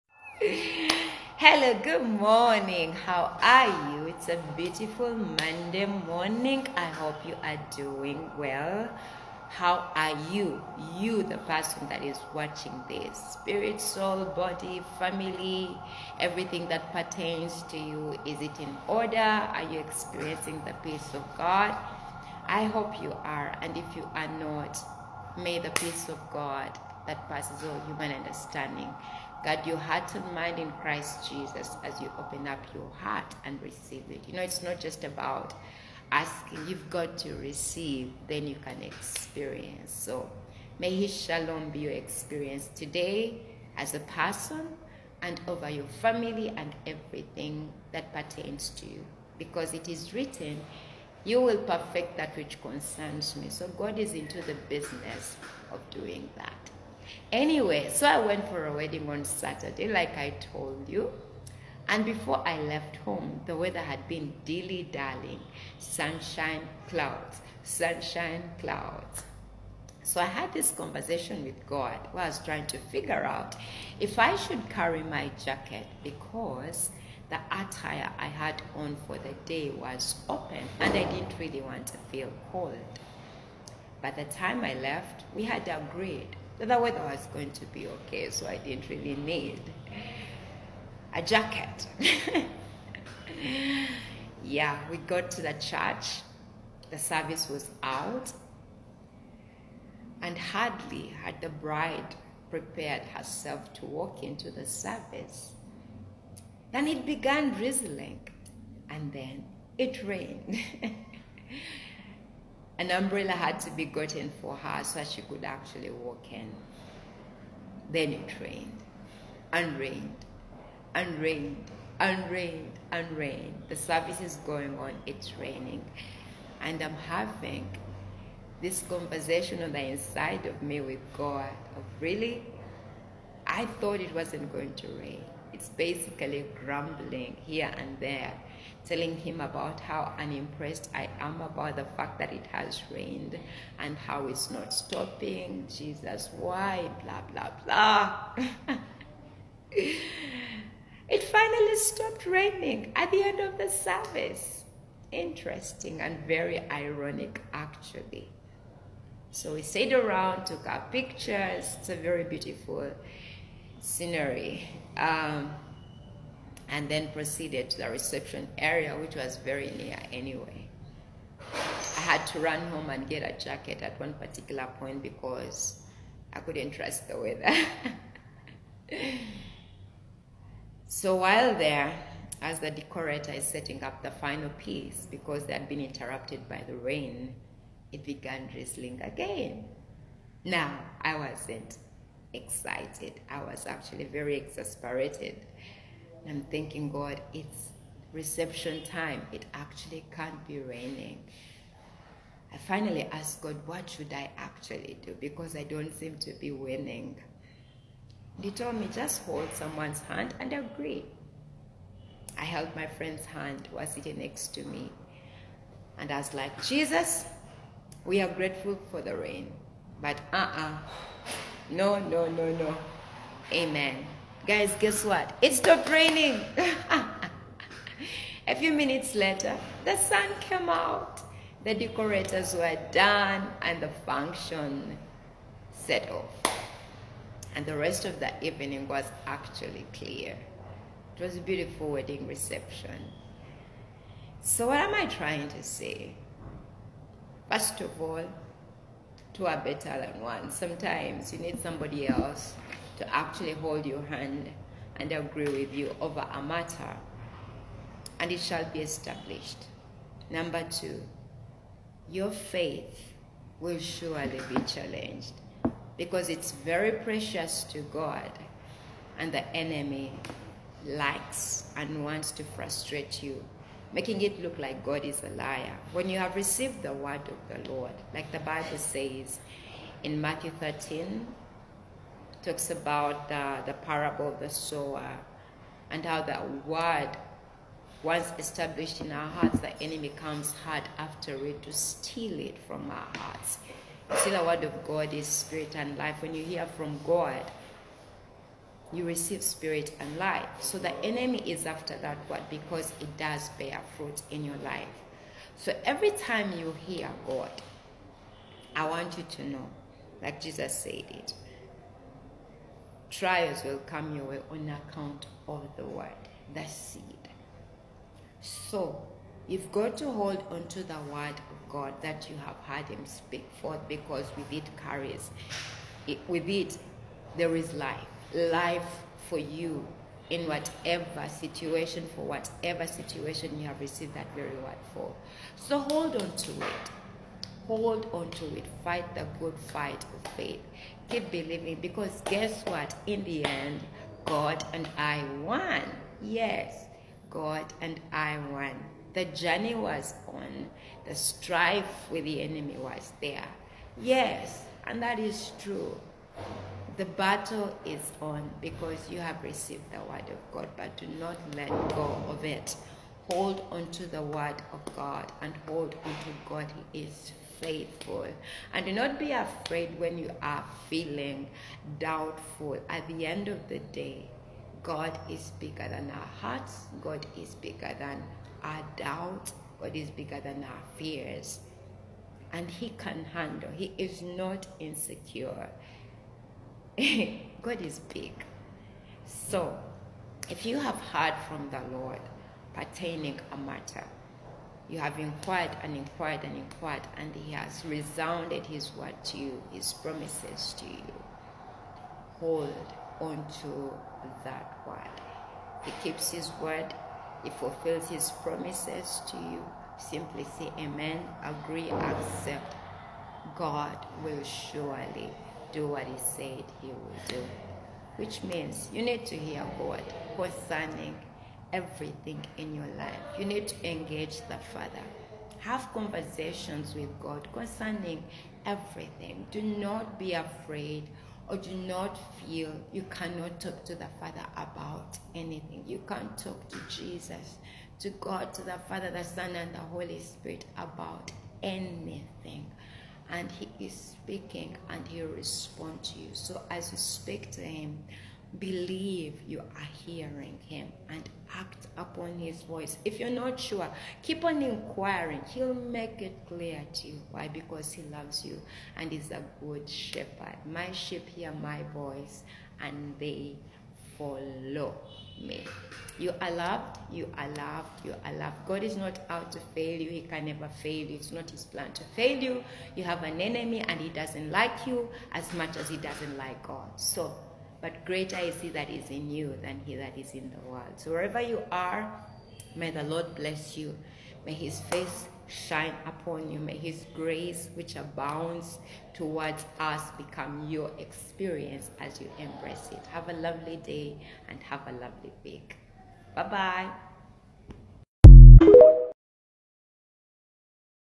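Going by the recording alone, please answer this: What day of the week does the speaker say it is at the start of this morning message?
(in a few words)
Monday.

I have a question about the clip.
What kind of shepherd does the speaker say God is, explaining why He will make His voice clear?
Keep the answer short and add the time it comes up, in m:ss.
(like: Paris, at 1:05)
A good shepherd, at 7:39.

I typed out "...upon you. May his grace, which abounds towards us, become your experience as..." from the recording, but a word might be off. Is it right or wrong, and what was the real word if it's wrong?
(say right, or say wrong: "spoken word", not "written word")
right.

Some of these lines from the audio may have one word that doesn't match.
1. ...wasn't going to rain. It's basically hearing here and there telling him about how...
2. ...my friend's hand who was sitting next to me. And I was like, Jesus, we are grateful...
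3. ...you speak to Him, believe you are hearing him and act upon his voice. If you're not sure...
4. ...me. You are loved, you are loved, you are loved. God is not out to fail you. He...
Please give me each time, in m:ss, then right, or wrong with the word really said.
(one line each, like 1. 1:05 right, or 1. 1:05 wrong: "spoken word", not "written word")
1. 2:14 wrong: "grumbling", not "hearing"
2. 3:32 right
3. 7:26 right
4. 7:45 right.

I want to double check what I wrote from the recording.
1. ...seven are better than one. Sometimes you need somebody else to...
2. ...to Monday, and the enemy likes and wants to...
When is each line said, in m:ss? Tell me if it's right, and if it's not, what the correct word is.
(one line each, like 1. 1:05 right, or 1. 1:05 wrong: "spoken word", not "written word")
1. 4:09 wrong: "two", not "seven"
2. 4:27 wrong: "God", not "Monday".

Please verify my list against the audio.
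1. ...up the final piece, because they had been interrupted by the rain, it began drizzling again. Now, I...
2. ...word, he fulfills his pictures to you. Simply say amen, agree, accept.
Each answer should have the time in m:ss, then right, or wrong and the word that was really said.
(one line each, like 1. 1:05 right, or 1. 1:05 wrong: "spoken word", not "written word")
1. 3:03 right
2. 6:46 wrong: "promises", not "pictures".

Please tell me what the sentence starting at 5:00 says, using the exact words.
So the enemy is after that word because it does bear fruit in your life.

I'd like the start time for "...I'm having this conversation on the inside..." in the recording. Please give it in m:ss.
2:06.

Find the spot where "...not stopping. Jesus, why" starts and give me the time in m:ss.
2:24.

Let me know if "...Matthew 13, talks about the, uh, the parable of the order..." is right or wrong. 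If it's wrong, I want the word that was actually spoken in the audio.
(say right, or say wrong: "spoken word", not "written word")
wrong: "sower", not "order".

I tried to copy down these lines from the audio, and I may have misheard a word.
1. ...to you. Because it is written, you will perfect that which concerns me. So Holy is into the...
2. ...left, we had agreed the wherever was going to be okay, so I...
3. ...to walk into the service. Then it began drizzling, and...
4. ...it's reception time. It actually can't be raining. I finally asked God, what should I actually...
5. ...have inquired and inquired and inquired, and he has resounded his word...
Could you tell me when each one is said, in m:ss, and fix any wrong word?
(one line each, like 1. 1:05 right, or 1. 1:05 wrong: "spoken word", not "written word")
1. 0:48 wrong: "God", not "Holy"
2. 1:24 wrong: "weather", not "wherever"
3. 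1:43 right
4. 3:17 right
5. 6:34 right.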